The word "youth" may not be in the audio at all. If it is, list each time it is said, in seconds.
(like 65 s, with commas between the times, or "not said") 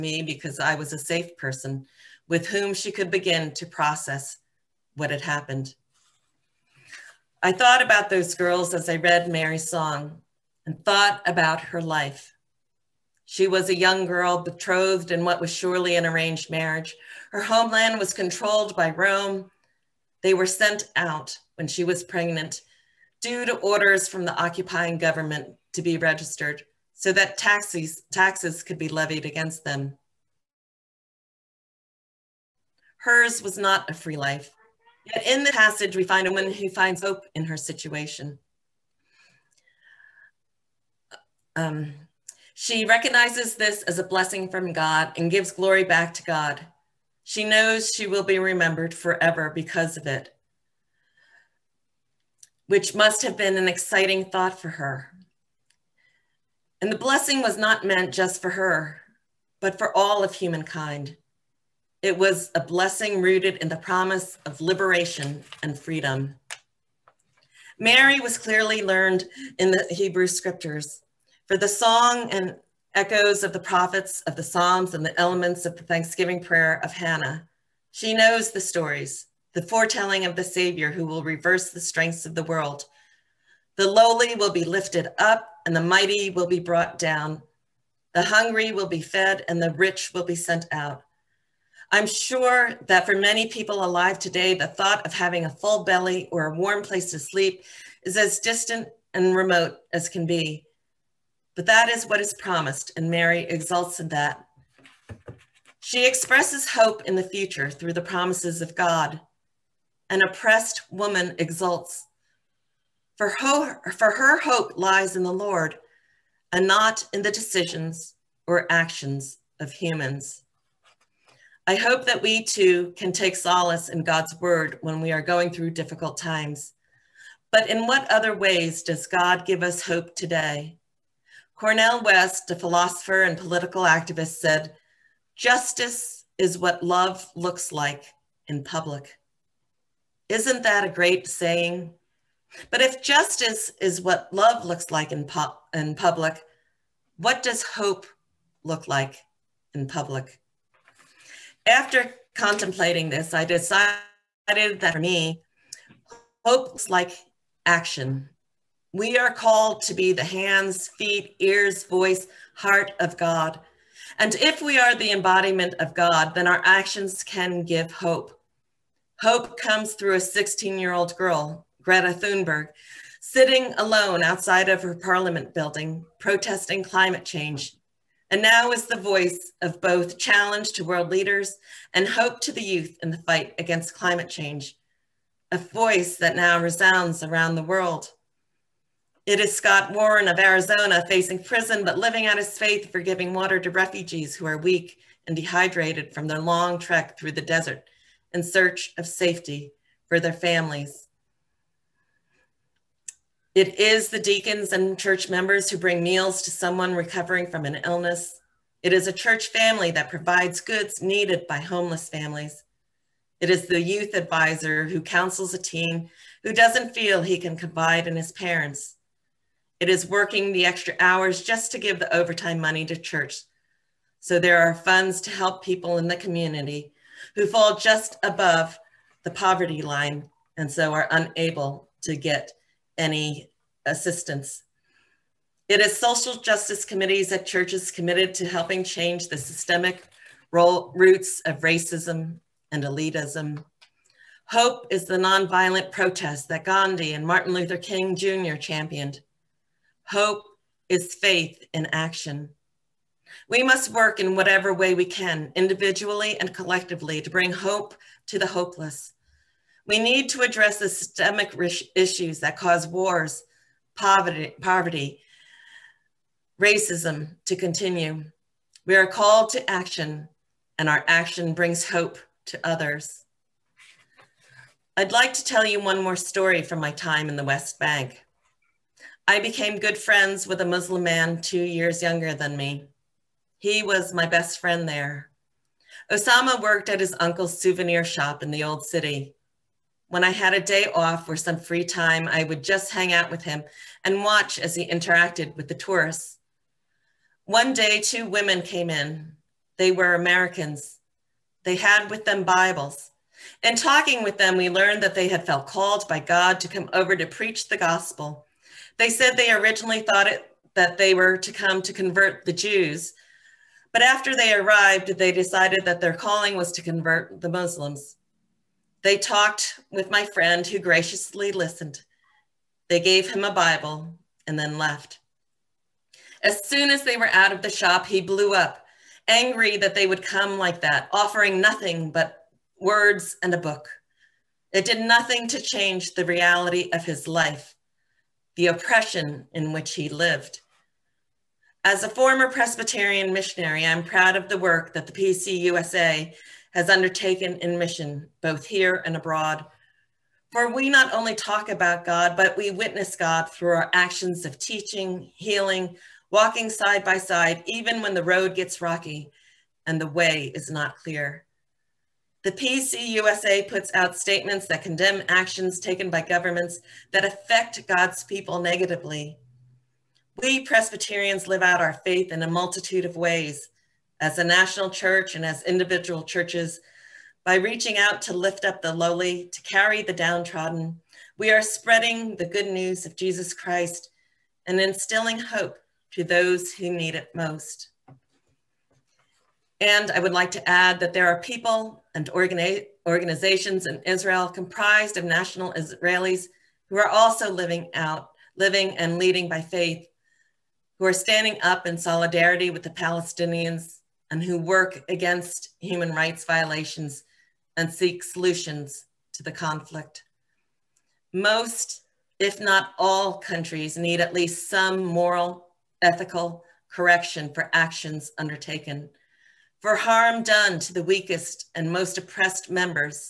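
182 s, 213 s.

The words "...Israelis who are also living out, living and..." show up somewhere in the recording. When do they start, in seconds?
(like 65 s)
395 s.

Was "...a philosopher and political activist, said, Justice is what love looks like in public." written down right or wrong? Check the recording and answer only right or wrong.
right.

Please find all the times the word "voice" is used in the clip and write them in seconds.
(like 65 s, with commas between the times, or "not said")
161 s, 178 s, 185 s.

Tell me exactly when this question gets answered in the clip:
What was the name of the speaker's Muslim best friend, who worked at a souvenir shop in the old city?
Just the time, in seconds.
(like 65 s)
286 s.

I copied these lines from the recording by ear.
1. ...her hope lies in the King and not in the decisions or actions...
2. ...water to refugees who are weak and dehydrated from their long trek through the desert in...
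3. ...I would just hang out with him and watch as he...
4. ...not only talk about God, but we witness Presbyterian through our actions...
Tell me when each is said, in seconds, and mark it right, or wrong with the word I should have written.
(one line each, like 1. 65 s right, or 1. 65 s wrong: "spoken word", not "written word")
1. 114 s wrong: "Lord", not "King"
2. 193 s right
3. 292 s right
4. 350 s wrong: "God", not "Presbyterian".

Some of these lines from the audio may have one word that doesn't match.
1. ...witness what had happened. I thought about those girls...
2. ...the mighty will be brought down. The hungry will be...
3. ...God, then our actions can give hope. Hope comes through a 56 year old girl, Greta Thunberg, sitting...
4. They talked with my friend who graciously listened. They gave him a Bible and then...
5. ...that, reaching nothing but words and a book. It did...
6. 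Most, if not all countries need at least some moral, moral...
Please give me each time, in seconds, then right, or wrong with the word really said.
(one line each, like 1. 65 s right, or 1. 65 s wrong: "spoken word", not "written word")
1. 3 s wrong: "process", not "witness"
2. 85 s right
3. 165 s wrong: "16", not "56"
4. 319 s right
5. 330 s wrong: "offering", not "reaching"
6. 411 s wrong: "ethical", not "moral".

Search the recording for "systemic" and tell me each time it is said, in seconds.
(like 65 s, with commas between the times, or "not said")
239 s, 260 s.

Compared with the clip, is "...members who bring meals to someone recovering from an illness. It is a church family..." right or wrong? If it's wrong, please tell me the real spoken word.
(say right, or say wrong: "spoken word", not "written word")
right.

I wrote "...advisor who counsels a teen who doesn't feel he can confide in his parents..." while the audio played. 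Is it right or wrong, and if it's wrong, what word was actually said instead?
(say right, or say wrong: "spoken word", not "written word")
right.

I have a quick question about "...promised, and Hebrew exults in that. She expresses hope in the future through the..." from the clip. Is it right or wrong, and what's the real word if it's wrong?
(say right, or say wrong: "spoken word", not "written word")
wrong: "Mary", not "Hebrew".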